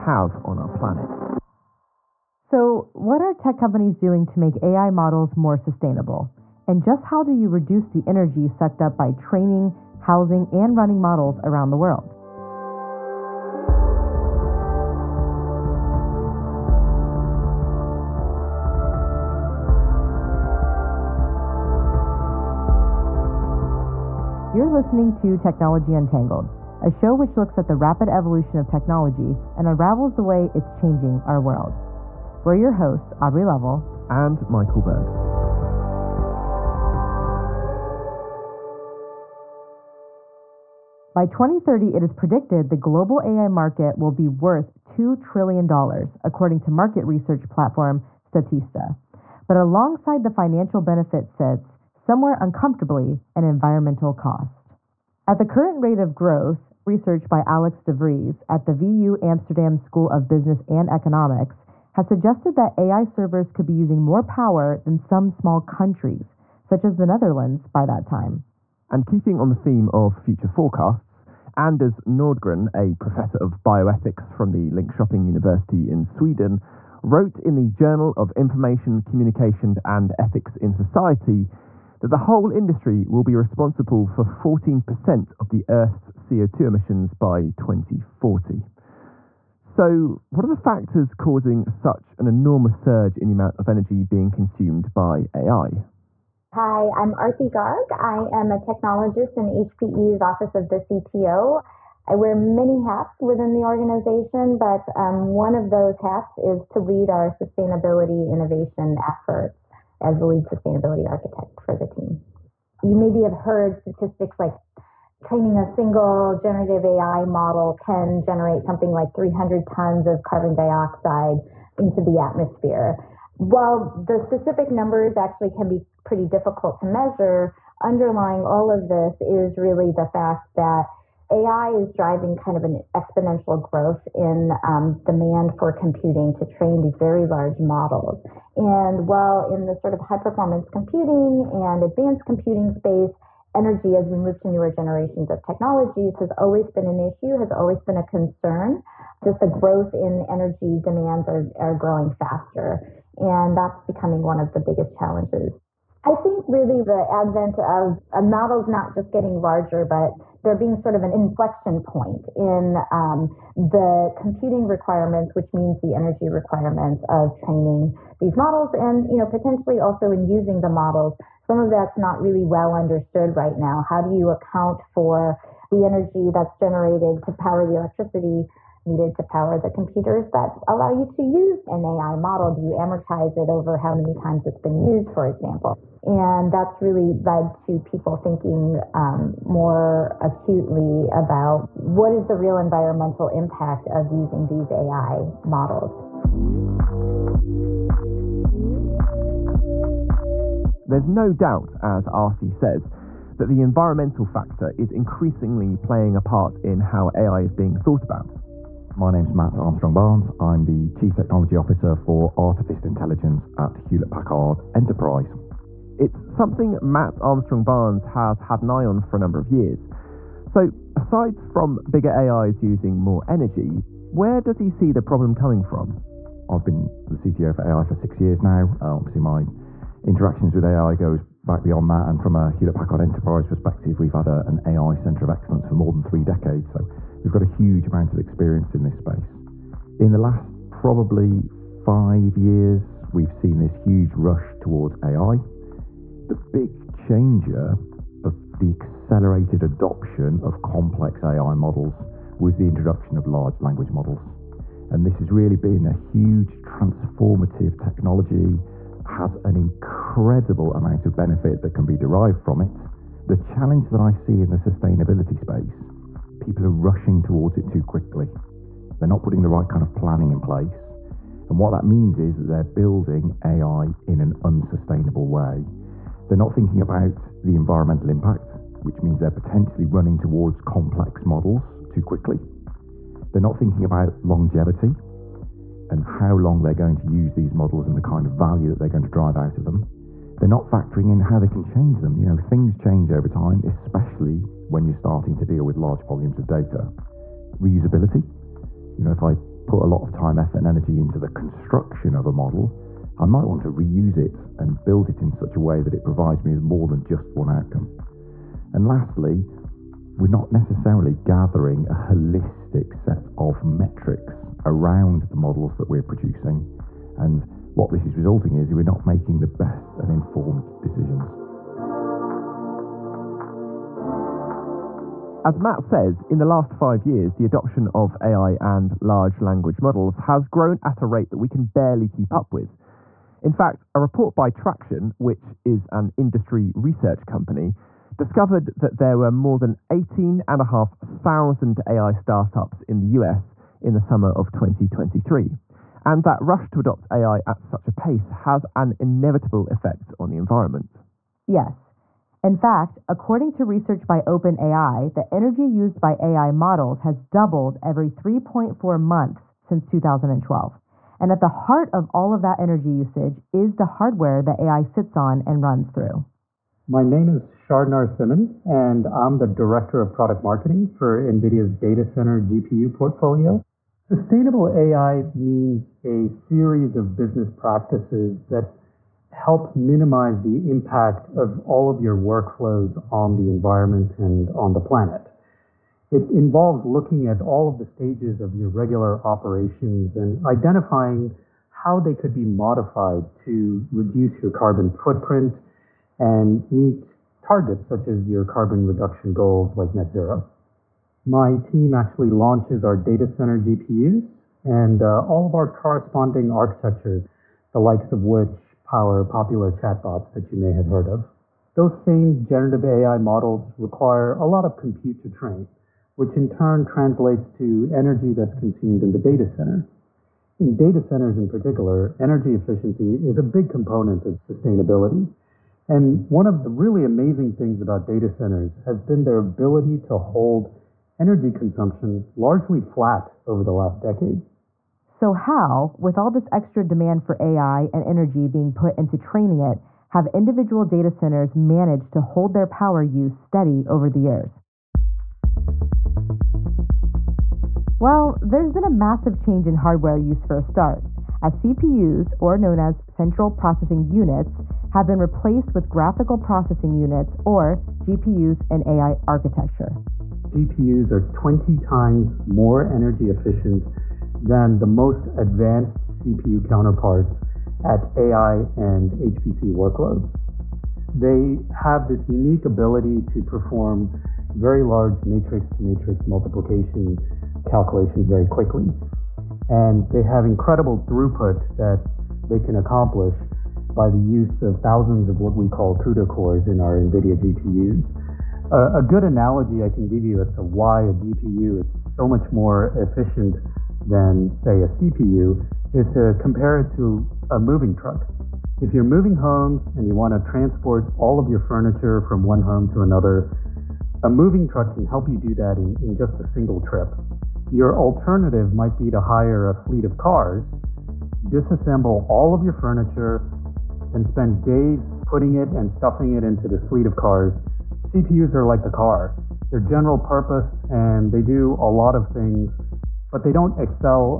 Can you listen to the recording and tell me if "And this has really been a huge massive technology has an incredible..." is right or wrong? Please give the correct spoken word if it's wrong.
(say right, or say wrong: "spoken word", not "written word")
wrong: "transformative", not "massive".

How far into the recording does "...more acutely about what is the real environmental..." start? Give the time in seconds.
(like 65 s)
189 s.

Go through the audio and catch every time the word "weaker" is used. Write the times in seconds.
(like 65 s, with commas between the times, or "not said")
not said.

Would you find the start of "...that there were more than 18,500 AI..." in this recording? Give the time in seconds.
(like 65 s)
338 s.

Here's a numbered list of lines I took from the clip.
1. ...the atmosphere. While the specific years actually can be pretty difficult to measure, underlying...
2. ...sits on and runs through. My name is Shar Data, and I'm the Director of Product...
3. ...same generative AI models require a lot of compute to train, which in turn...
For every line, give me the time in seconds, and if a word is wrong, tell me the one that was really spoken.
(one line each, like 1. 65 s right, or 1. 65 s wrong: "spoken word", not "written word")
1. 122 s wrong: "numbers", not "years"
2. 364 s wrong: "Narasimhan", not "Data"
3. 411 s right.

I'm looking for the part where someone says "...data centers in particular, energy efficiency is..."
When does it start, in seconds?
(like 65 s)
420 s.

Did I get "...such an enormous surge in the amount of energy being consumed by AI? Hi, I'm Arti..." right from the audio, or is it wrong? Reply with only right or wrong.
right.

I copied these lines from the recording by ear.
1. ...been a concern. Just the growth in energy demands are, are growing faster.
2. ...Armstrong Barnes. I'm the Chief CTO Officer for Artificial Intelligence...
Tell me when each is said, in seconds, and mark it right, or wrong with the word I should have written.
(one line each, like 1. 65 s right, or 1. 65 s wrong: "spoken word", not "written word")
1. 147 s right
2. 209 s wrong: "Technology", not "CTO".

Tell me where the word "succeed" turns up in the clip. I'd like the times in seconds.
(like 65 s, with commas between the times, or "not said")
not said.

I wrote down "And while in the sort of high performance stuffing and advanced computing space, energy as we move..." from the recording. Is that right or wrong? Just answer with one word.
wrong.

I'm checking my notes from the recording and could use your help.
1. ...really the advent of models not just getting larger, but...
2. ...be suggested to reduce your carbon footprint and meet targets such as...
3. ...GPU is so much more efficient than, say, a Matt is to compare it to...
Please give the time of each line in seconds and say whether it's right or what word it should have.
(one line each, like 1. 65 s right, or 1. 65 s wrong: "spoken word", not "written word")
1. 156 s right
2. 392 s wrong: "modified", not "suggested"
3. 491 s wrong: "CPU", not "Matt".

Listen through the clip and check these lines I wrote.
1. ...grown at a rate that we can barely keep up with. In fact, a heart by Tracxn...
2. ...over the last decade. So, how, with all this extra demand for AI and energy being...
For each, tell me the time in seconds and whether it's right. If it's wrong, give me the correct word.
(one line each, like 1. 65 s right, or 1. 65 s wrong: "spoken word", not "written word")
1. 330 s wrong: "report", not "heart"
2. 433 s right.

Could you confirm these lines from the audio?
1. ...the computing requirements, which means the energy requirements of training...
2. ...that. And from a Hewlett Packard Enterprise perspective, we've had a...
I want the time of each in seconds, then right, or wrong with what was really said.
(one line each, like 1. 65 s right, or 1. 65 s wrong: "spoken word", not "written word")
1. 163 s right
2. 231 s right.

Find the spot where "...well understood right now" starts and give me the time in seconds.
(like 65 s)
172 s.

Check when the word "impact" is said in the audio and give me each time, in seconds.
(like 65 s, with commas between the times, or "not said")
193 s, 278 s, 380 s.